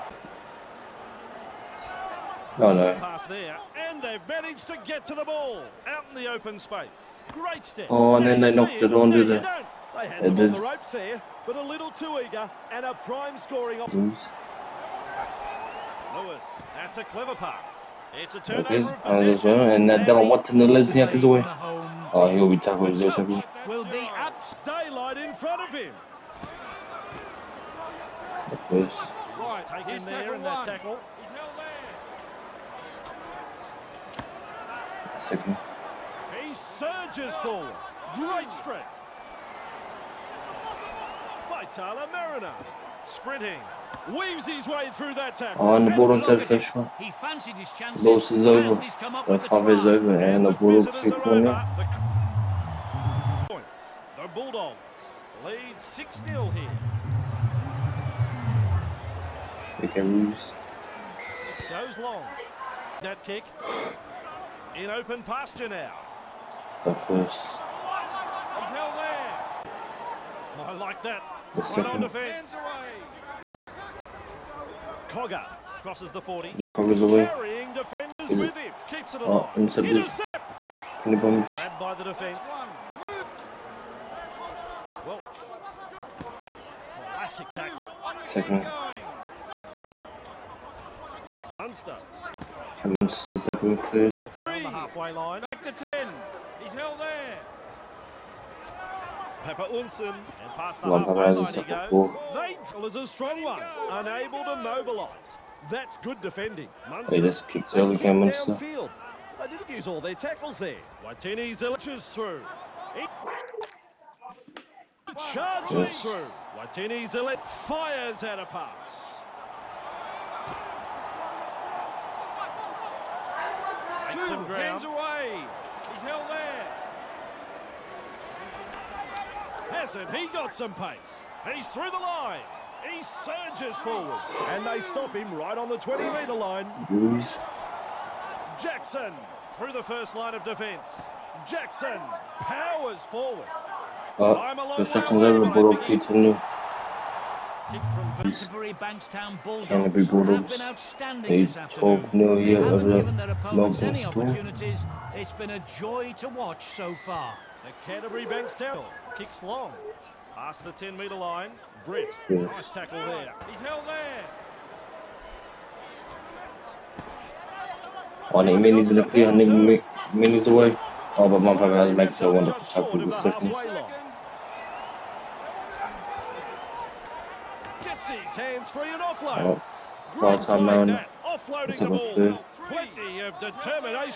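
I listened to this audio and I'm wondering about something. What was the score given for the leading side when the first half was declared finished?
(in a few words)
6-0.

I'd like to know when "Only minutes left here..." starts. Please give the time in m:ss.
2:48.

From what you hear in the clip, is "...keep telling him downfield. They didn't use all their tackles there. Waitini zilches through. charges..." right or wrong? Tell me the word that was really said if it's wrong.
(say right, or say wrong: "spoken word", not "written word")
right.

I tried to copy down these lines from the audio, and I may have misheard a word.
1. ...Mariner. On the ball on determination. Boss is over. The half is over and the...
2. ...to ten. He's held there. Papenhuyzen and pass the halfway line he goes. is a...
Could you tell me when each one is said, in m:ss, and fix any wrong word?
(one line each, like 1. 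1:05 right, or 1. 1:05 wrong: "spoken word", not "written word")
1. 0:42 wrong: "television", not "determination"
2. 1:35 right.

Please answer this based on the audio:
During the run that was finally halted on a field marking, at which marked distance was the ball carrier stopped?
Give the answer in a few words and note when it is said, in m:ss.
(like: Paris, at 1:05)
20-metre line, at 2:15.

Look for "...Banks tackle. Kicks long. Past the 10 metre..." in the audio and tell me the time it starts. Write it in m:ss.
2:38.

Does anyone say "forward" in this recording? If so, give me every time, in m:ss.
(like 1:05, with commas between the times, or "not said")
0:37, 2:13, 2:23.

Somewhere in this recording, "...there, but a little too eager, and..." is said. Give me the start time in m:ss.
0:10.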